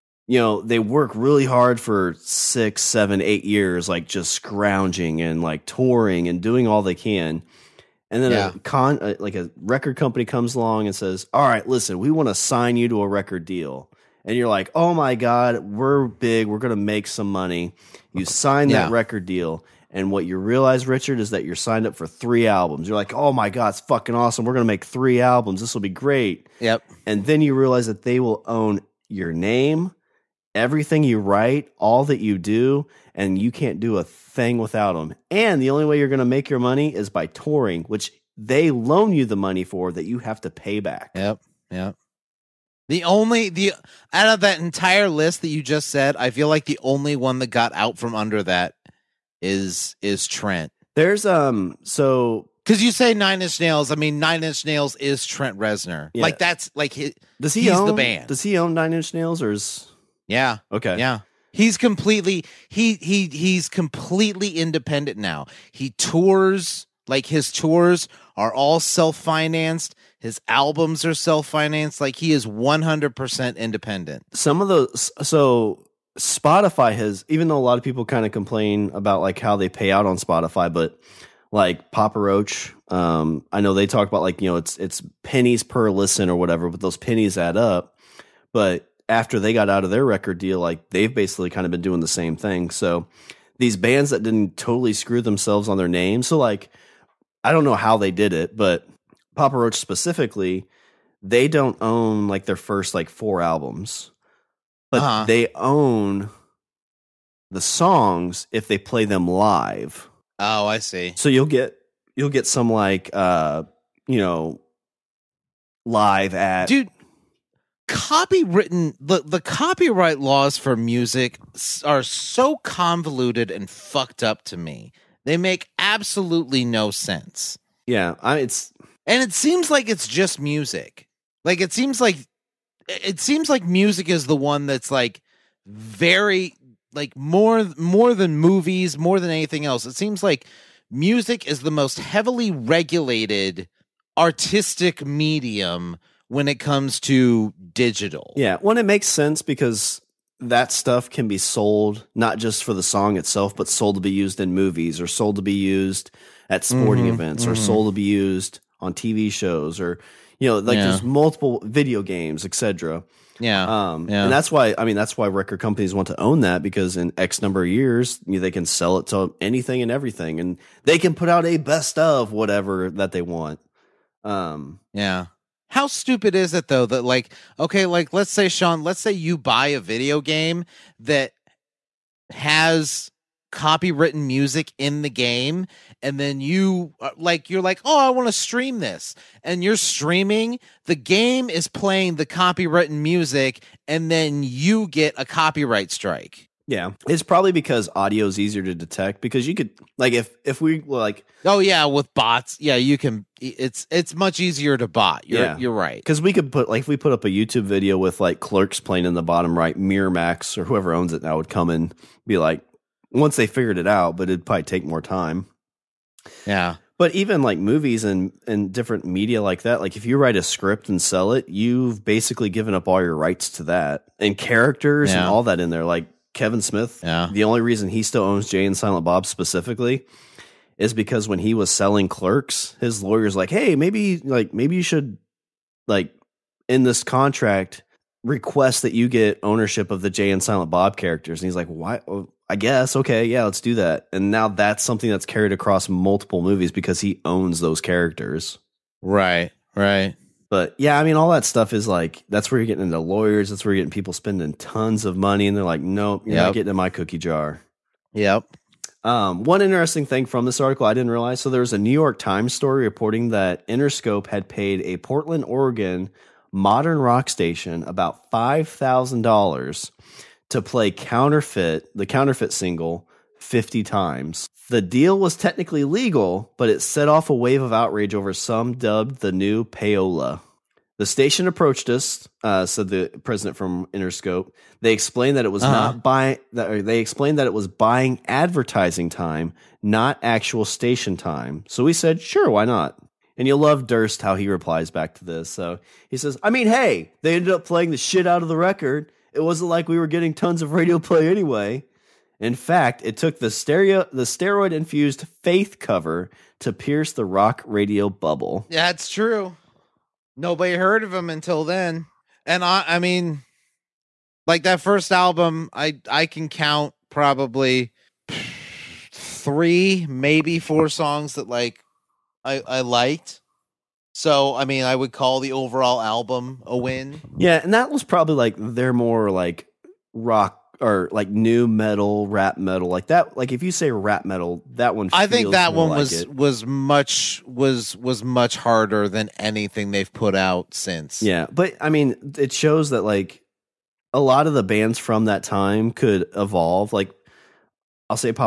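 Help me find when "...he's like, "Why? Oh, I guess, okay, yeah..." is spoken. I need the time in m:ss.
4:01.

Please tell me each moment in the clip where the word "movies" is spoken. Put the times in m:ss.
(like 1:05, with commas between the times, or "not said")
2:18, 2:34, 3:37, 4:06.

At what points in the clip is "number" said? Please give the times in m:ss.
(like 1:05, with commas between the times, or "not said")
2:47.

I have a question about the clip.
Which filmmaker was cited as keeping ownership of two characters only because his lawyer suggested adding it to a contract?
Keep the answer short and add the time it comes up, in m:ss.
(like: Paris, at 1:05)
Kevin Smith, at 3:46.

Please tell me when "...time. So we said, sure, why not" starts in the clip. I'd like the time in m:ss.
4:51.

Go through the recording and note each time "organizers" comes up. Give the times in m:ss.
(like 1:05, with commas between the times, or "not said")
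not said.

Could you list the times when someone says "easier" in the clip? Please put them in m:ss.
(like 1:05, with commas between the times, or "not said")
3:18, 3:24.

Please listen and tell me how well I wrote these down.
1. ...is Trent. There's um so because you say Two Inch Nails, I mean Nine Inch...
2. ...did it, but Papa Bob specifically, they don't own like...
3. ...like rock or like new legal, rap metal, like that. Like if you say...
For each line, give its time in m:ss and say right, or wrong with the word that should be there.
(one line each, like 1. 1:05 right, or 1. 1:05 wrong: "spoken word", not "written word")
1. 0:50 wrong: "Nine", not "Two"
2. 1:38 wrong: "Roach", not "Bob"
3. 5:29 wrong: "metal", not "legal".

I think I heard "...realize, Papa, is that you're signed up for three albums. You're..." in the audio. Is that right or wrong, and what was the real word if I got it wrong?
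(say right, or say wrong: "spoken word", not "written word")
wrong: "Richard", not "Papa".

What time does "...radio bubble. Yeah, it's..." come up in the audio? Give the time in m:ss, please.
5:07.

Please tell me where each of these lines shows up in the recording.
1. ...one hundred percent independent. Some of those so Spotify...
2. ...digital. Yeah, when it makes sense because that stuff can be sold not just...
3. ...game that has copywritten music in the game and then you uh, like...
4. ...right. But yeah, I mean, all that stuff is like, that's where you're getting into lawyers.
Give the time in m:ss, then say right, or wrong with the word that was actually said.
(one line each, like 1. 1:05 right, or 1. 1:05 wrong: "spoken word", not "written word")
1. 1:12 right
2. 2:27 right
3. 3:00 right
4. 4:09 right.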